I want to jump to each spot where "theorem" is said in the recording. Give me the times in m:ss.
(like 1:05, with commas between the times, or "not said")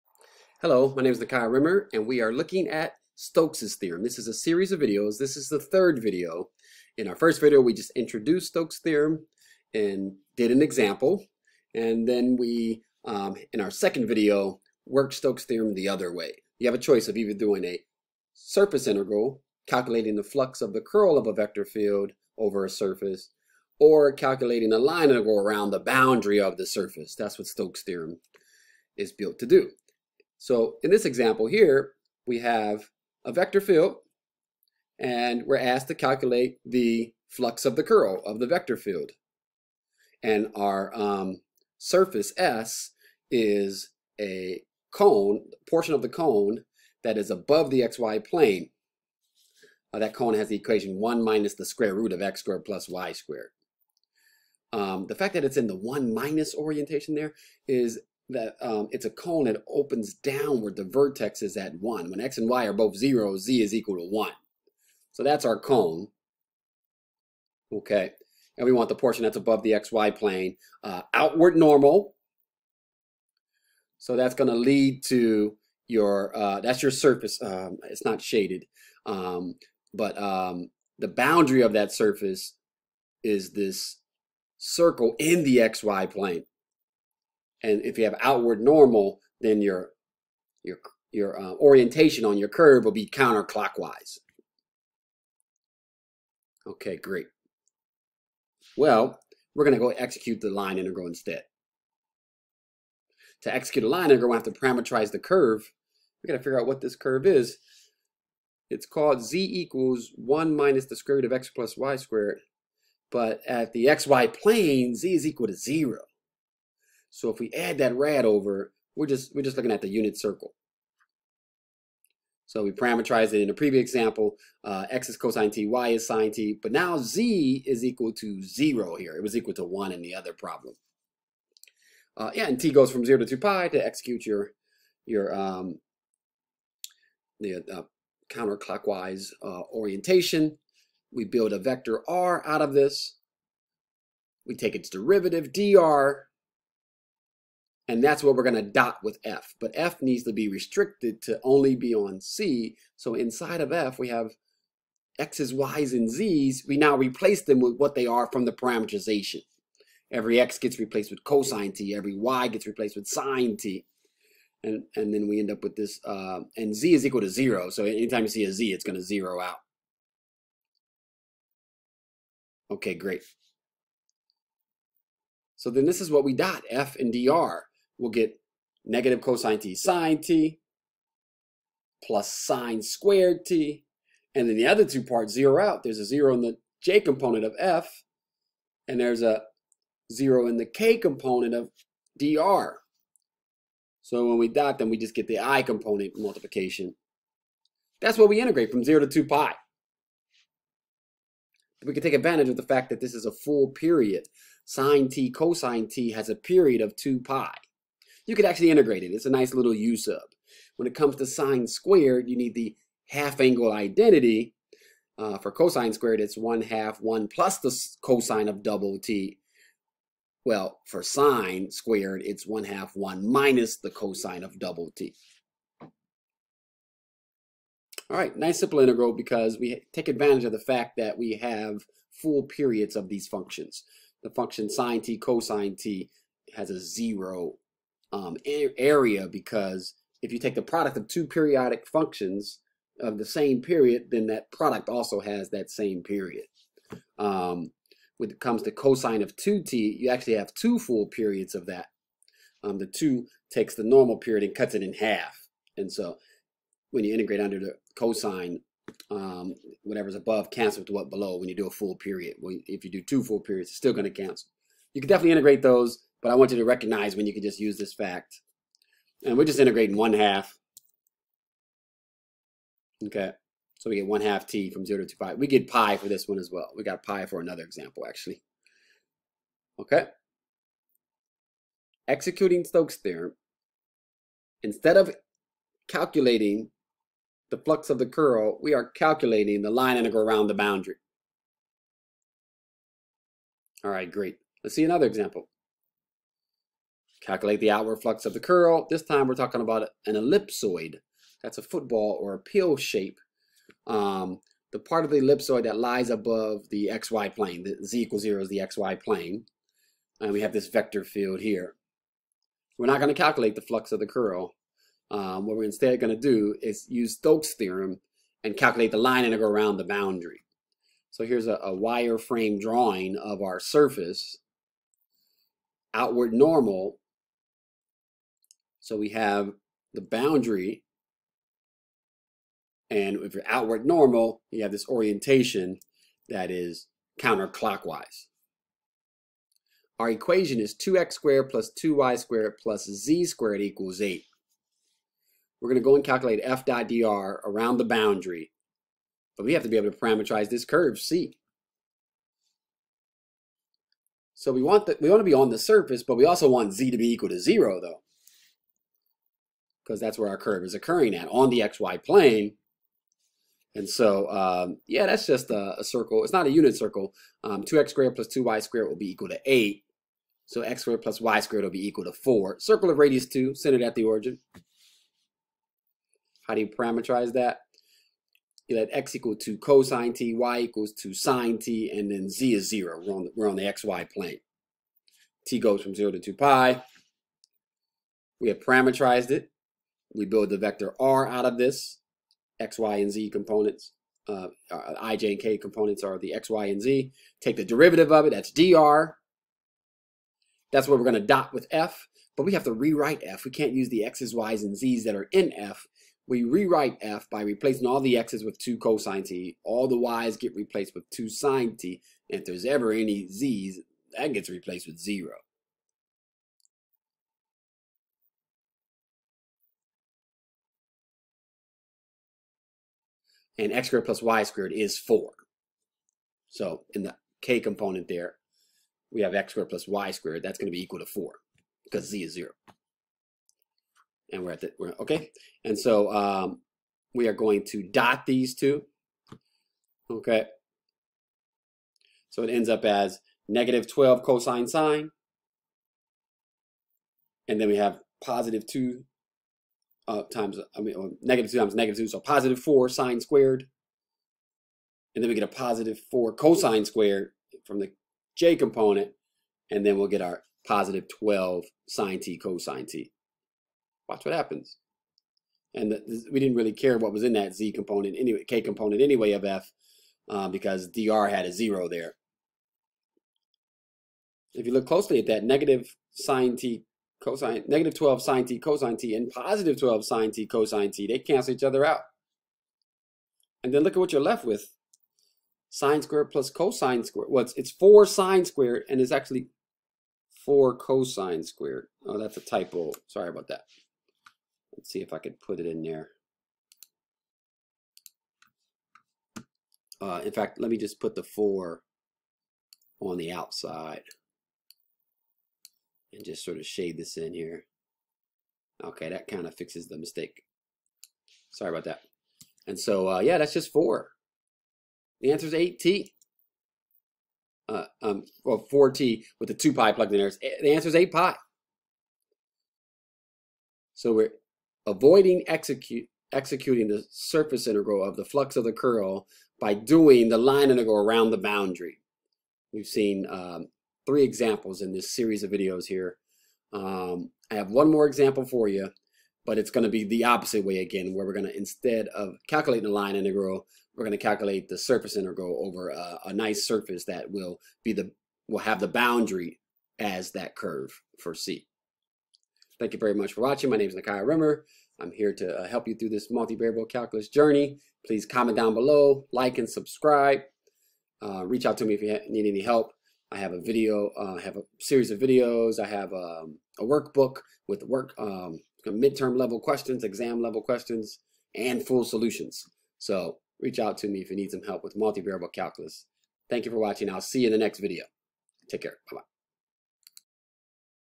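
0:03, 0:08, 0:15, 0:27, 4:42, 5:17.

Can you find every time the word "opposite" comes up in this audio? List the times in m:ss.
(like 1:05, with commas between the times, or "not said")
9:00.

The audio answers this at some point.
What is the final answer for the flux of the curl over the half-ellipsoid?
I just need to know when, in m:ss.
8:40.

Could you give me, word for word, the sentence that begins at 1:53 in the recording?
But at the xy plane, z is equal to 0.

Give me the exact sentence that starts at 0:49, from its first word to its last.
Uh, that cone has the equation 1 minus the square root of x squared plus y squared.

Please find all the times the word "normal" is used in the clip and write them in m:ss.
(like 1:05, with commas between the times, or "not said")
1:11, 1:28, 4:13, 5:26, 5:33.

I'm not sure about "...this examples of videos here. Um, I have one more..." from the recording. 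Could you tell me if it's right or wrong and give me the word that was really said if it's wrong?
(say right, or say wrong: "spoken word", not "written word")
wrong: "series", not "examples".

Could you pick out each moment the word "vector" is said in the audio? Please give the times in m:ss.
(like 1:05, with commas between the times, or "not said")
0:21, 0:33, 0:38, 2:21, 5:10, 6:30.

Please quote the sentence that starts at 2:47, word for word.
So anytime you see a Z, it's going to zero out.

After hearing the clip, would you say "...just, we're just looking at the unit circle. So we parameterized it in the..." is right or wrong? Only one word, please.
right.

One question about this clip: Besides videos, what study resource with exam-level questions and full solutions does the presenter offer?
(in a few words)
a workbook.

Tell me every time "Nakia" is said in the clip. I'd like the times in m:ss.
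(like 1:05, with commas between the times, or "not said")
0:01, 9:13.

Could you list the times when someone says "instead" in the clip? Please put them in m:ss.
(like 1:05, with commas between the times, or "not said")
1:41, 4:44, 5:15, 9:01.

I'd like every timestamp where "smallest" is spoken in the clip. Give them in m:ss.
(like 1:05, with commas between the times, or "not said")
not said.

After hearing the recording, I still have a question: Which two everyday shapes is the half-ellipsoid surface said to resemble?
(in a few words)
a football or a pill.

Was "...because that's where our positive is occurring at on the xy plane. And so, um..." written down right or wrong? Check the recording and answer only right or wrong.
wrong.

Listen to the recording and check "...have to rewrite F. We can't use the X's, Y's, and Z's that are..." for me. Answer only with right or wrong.
right.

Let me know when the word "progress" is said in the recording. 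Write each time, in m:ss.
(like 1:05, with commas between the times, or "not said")
not said.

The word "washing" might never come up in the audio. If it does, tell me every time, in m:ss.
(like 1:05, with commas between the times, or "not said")
not said.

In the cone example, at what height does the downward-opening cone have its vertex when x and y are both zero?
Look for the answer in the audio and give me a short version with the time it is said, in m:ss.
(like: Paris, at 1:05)
1, at 1:00.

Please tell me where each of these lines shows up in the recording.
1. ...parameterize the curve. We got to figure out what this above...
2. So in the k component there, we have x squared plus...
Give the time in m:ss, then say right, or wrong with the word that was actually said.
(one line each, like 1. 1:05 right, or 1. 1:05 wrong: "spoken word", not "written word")
1. 1:44 wrong: "curve", not "above"
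2. 7:06 right.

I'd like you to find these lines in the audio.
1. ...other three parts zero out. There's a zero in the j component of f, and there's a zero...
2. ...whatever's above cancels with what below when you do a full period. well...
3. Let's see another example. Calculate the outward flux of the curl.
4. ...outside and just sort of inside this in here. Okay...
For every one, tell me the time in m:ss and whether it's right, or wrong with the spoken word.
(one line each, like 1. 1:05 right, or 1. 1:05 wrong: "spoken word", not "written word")
1. 3:04 wrong: "two", not "three"
2. 4:19 right
3. 4:54 right
4. 8:23 wrong: "shade", not "inside".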